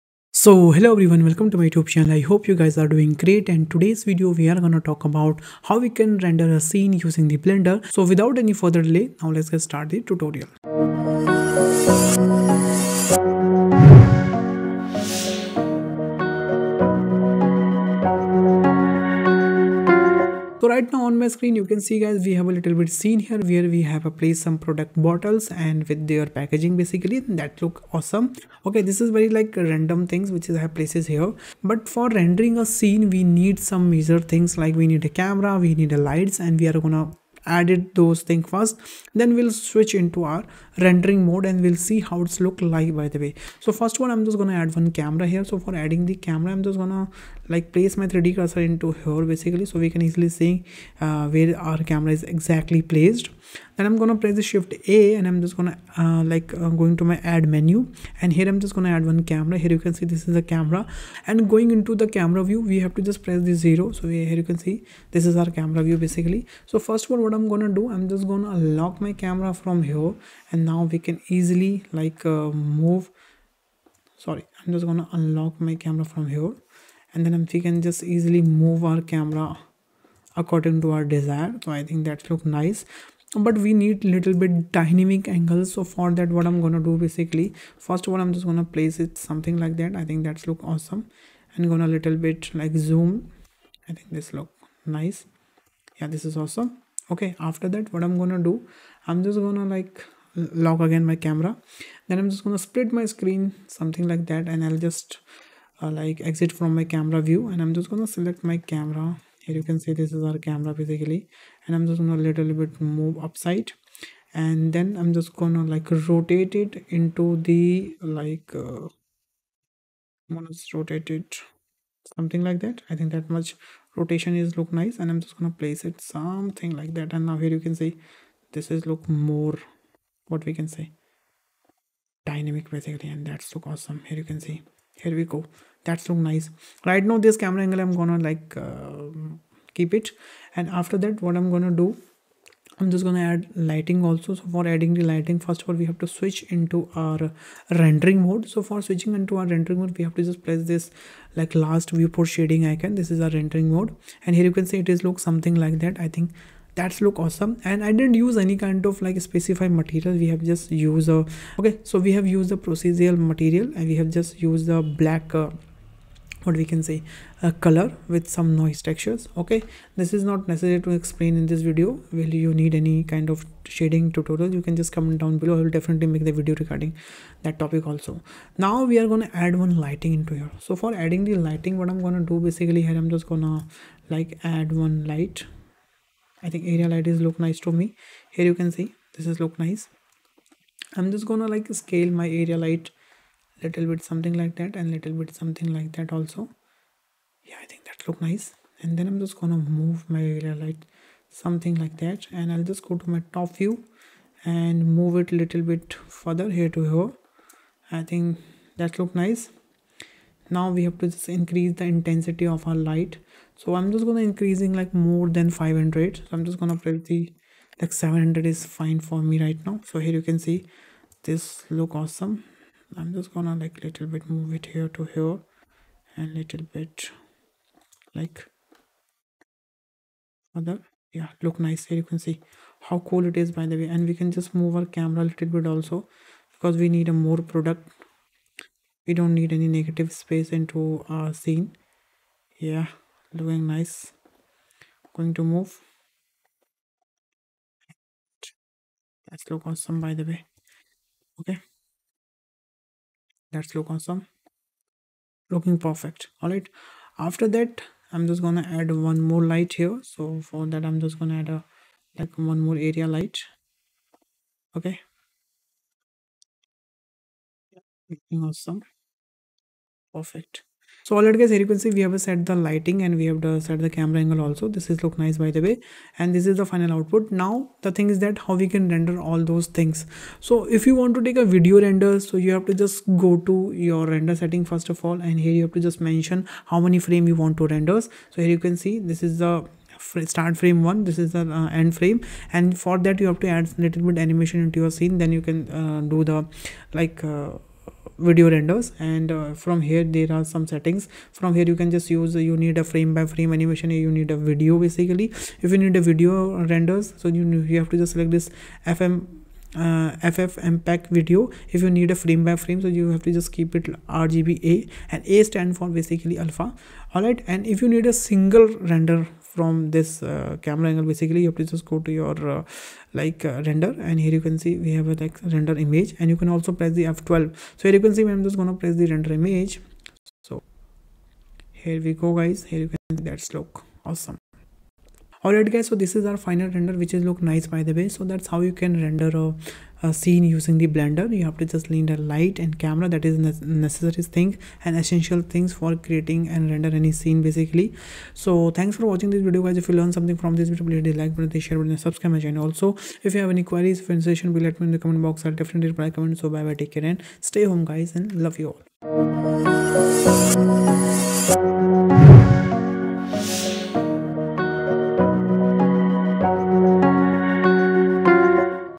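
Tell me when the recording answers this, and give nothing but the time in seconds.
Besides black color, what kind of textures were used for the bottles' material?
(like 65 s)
168 s.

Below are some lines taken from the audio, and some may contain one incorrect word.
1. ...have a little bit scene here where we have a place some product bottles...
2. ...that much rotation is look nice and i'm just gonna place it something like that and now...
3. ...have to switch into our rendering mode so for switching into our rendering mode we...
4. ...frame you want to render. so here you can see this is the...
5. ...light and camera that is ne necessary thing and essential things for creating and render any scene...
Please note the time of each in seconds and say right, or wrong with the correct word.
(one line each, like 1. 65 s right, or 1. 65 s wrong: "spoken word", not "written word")
1. 22 s right
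2. 123 s right
3. 145 s right
4. 286 s right
5. 342 s right.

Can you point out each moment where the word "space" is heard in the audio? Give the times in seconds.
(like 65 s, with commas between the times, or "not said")
240 s.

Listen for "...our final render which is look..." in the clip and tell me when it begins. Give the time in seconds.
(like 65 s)
336 s.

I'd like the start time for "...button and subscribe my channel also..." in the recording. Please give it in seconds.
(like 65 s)
351 s.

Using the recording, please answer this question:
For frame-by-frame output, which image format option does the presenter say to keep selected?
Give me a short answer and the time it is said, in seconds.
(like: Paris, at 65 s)
RGBA, at 314 s.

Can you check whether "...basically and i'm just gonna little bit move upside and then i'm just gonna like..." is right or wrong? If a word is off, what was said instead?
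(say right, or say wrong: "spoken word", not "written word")
right.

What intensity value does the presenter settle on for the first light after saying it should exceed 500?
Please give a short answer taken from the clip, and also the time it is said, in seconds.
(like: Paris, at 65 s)
700, at 217 s.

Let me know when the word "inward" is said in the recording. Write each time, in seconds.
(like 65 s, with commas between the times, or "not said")
not said.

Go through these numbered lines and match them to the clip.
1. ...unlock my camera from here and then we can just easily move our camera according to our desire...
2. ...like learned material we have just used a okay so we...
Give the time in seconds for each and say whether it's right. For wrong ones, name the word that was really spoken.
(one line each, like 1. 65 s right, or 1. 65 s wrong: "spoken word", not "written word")
1. 75 s right
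2. 159 s wrong: "specified", not "learned".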